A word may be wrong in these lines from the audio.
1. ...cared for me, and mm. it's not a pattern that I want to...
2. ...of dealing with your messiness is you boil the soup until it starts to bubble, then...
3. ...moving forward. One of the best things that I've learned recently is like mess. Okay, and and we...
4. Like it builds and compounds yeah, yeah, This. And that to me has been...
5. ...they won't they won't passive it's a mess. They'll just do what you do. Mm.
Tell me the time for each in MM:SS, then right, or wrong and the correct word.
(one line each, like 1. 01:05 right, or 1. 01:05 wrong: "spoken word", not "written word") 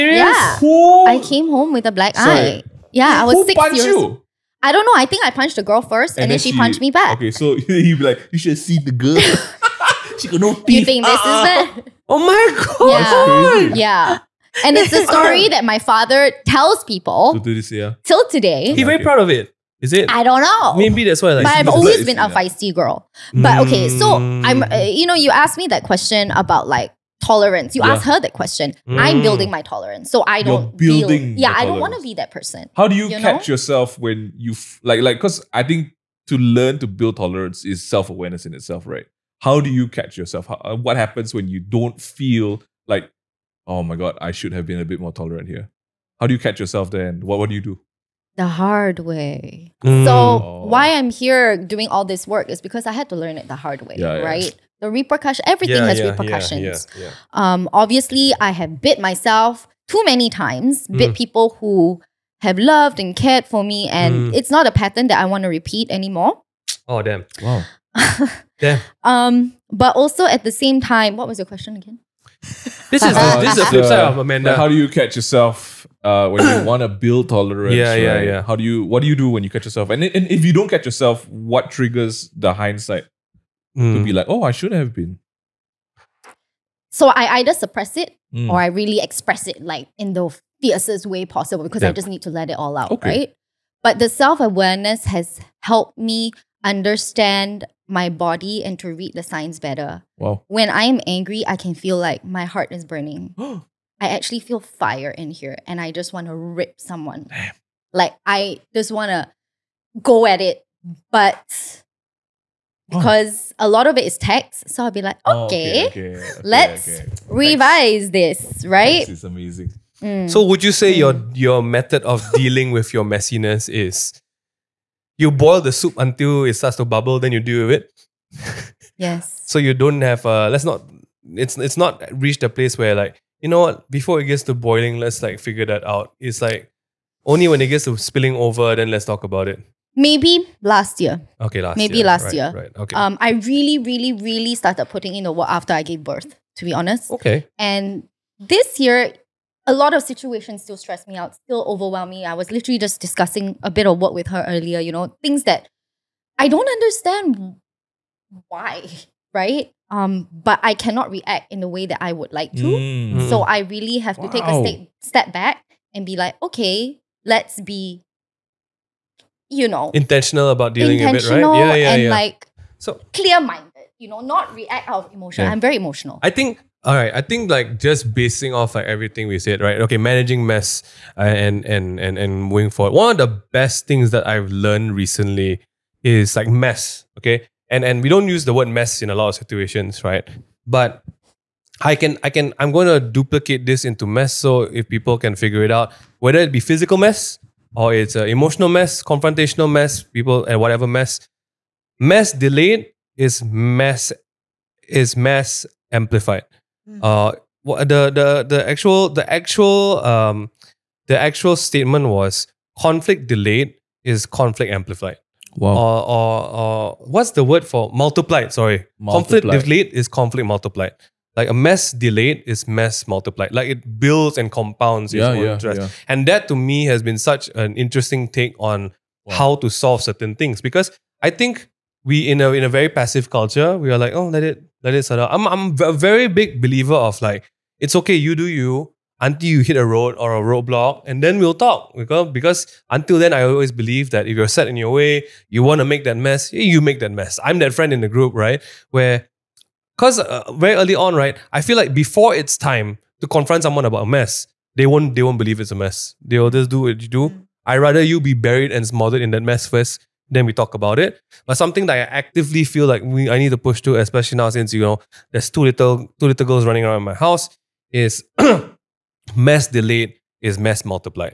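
1. 01:03 right
2. 02:02 right
3. 03:02 right
4. 03:43 wrong: "Yeah", not "This"
5. 04:14 wrong: "believe", not "passive".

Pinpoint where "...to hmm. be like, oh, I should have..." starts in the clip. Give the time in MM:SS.
01:23.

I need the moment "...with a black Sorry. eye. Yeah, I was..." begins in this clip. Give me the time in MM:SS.
00:01.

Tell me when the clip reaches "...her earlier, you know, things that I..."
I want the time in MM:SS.
02:34.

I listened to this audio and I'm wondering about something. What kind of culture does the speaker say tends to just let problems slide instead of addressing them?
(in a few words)
Passive culture.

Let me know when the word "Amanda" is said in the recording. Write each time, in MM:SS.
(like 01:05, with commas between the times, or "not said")
01:14.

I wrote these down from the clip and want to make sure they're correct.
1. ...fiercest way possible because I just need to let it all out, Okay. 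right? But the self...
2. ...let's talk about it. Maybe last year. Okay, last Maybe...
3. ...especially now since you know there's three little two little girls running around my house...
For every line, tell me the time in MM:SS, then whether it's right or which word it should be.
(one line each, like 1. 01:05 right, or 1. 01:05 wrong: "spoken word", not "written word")
1. 01:30 right
2. 02:18 right
3. 04:23 wrong: "two", not "three".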